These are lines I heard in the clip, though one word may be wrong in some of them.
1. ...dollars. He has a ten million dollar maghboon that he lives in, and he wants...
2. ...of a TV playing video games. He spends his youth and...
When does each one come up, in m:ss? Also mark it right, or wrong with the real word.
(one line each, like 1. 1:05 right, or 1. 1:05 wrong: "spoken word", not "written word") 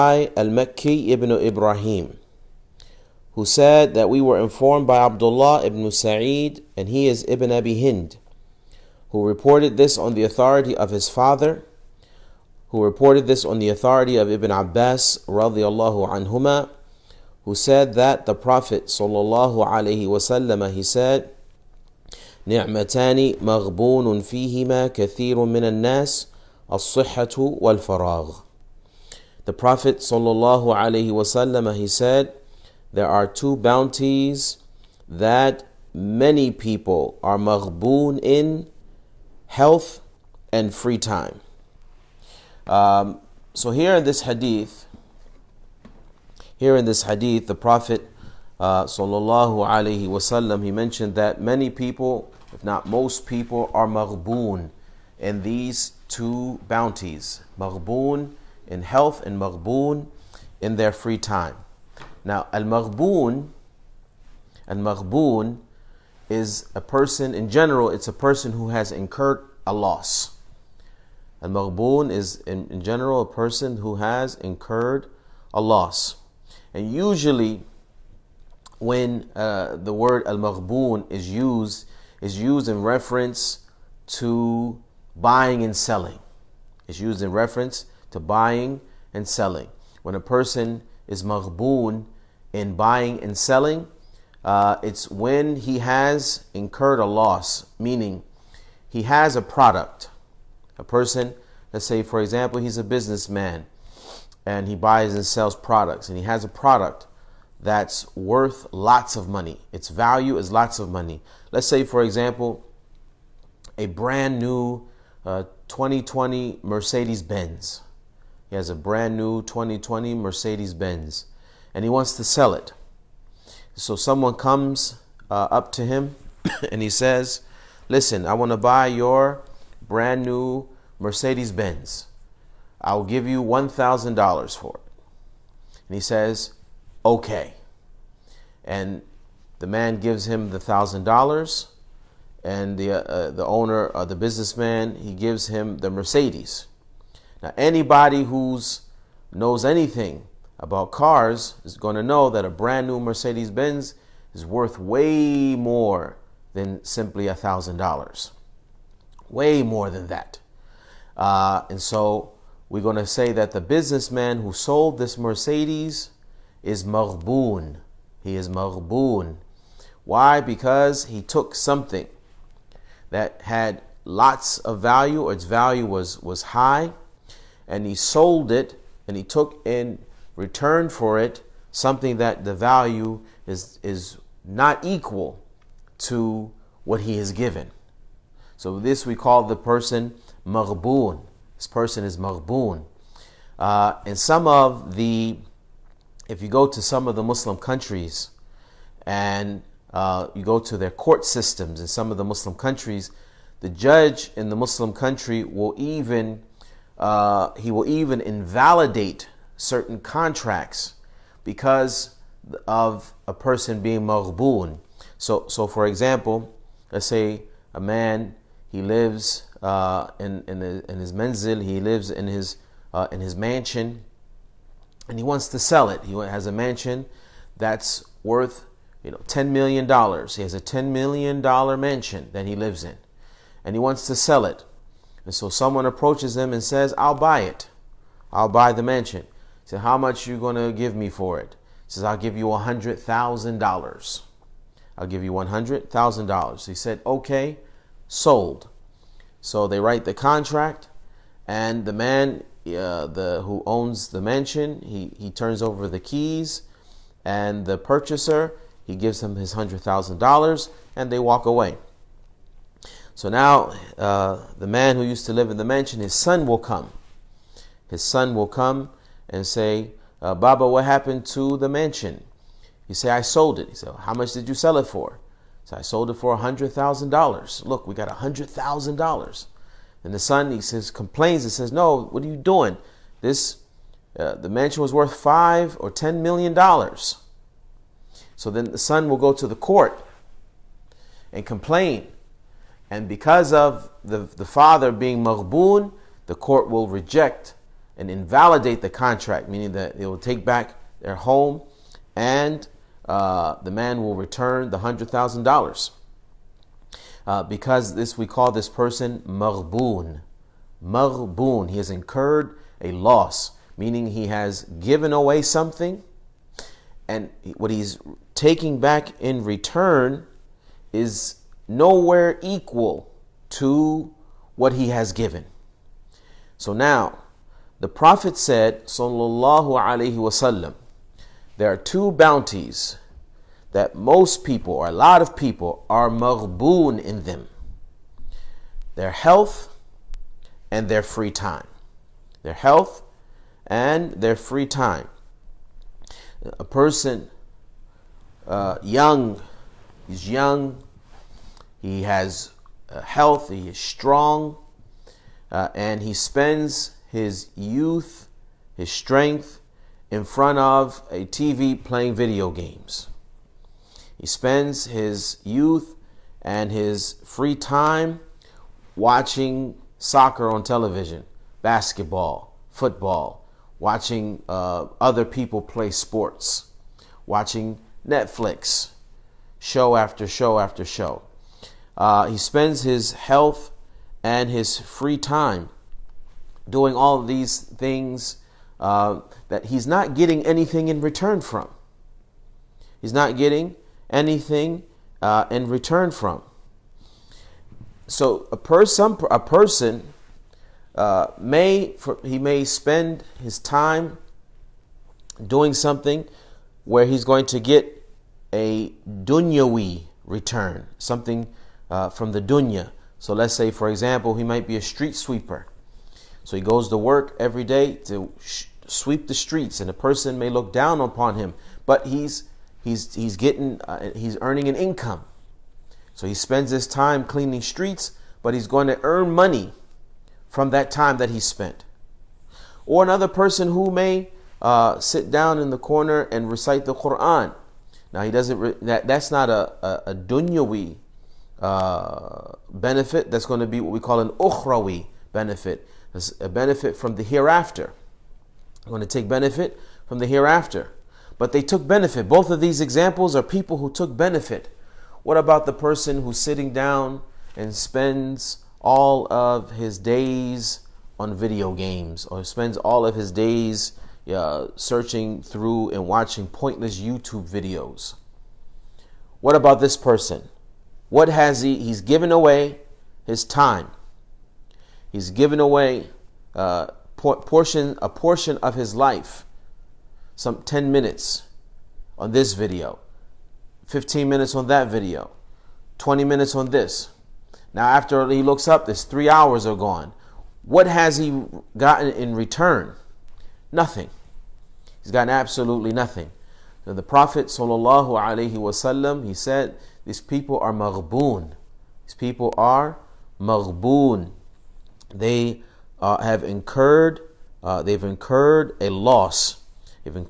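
1. 3:49 wrong: "mansion", not "maghboon"
2. 6:00 right.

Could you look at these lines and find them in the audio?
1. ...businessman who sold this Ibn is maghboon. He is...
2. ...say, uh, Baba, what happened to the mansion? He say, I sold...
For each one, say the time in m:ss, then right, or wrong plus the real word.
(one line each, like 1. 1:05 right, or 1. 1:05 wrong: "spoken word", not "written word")
1. 2:43 wrong: "Mercedes", not "Ibn"
2. 4:29 right.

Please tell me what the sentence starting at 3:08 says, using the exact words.
So this we call the person maghboon.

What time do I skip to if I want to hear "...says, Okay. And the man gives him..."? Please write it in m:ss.
2:16.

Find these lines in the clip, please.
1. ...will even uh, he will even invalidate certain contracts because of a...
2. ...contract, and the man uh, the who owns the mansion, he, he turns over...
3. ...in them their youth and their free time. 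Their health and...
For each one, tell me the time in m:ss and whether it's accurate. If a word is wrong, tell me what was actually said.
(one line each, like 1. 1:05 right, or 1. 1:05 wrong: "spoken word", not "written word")
1. 3:25 right
2. 4:10 right
3. 5:37 wrong: "health", not "youth".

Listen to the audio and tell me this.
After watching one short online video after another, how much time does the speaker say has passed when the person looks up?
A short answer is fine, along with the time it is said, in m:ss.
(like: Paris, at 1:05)
3 hours, at 8:09.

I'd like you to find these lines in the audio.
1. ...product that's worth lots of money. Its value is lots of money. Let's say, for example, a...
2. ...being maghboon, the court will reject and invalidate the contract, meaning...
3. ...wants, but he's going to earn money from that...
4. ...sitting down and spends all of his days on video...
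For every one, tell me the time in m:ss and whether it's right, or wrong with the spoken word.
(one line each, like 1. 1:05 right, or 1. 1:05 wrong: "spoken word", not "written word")
1. 1:46 right
2. 4:54 right
3. 7:07 wrong: "streets", not "wants"
4. 7:36 right.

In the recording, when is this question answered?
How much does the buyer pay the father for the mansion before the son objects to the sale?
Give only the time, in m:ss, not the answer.
4:05.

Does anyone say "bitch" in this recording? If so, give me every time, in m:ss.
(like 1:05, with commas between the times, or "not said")
not said.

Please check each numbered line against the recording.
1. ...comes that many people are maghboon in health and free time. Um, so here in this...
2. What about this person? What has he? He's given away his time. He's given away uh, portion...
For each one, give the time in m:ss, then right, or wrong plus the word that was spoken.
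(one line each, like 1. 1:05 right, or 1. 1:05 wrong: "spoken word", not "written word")
1. 0:33 wrong: "bounties", not "comes"
2. 7:49 right.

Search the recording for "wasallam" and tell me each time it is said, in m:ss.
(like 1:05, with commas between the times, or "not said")
0:20, 0:50, 5:30, 8:18.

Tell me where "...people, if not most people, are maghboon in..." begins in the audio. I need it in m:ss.
0:51.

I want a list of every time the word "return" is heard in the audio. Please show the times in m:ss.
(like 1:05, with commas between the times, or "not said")
3:00, 5:04, 5:19, 6:31, 6:35, 6:50, 8:12.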